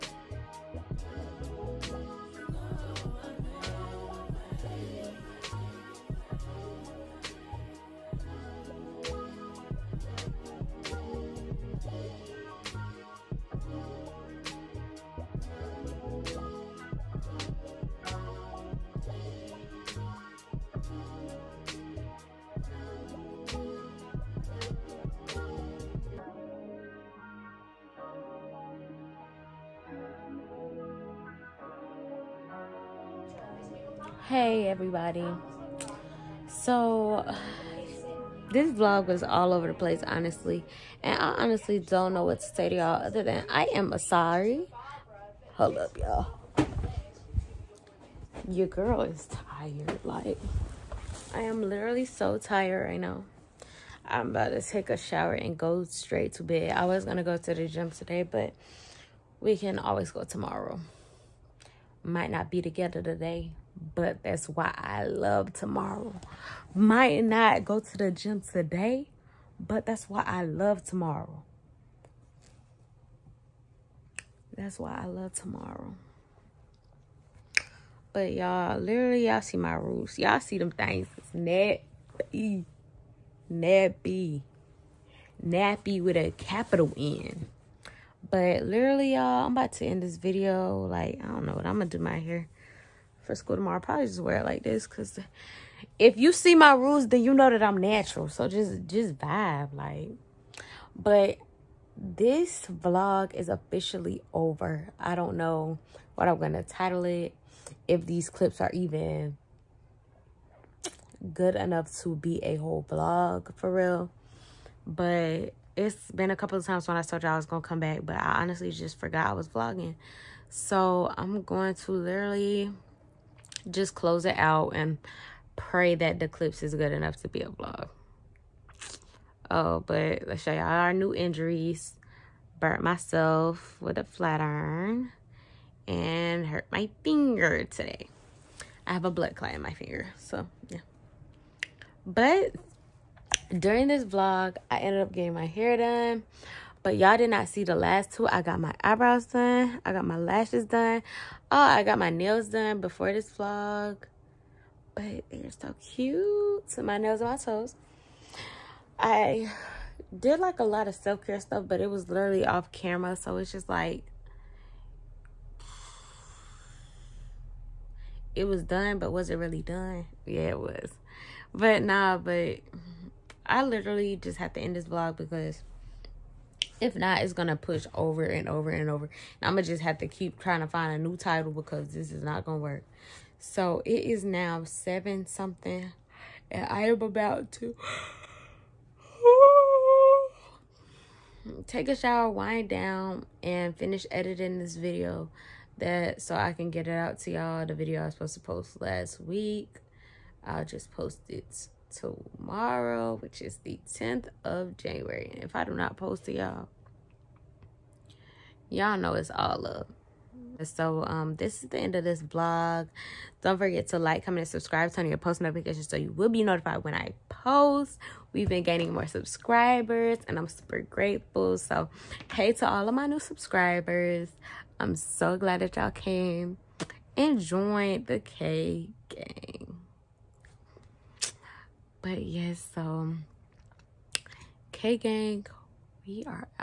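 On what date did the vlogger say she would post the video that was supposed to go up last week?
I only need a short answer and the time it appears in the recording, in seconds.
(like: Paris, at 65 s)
January 10, at 203 s.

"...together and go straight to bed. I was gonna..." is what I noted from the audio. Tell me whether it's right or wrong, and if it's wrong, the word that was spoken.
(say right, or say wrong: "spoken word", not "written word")
wrong: "shower", not "together".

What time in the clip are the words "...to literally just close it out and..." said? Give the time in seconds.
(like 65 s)
121 s.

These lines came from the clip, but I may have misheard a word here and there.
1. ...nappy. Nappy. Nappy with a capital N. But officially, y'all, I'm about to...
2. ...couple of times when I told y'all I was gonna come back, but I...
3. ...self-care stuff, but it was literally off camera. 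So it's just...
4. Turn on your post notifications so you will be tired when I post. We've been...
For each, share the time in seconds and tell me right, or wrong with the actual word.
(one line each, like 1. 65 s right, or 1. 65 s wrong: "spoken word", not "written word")
1. 81 s wrong: "literally", not "officially"
2. 116 s right
3. 160 s right
4. 214 s wrong: "notified", not "tired".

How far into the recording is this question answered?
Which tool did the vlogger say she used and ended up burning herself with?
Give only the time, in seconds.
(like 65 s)
134 s.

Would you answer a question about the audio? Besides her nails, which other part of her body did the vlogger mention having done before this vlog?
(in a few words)
toes.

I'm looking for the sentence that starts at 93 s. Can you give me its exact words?
I'll probably just wear it like this because if you see my rules, then you know that I'm natural.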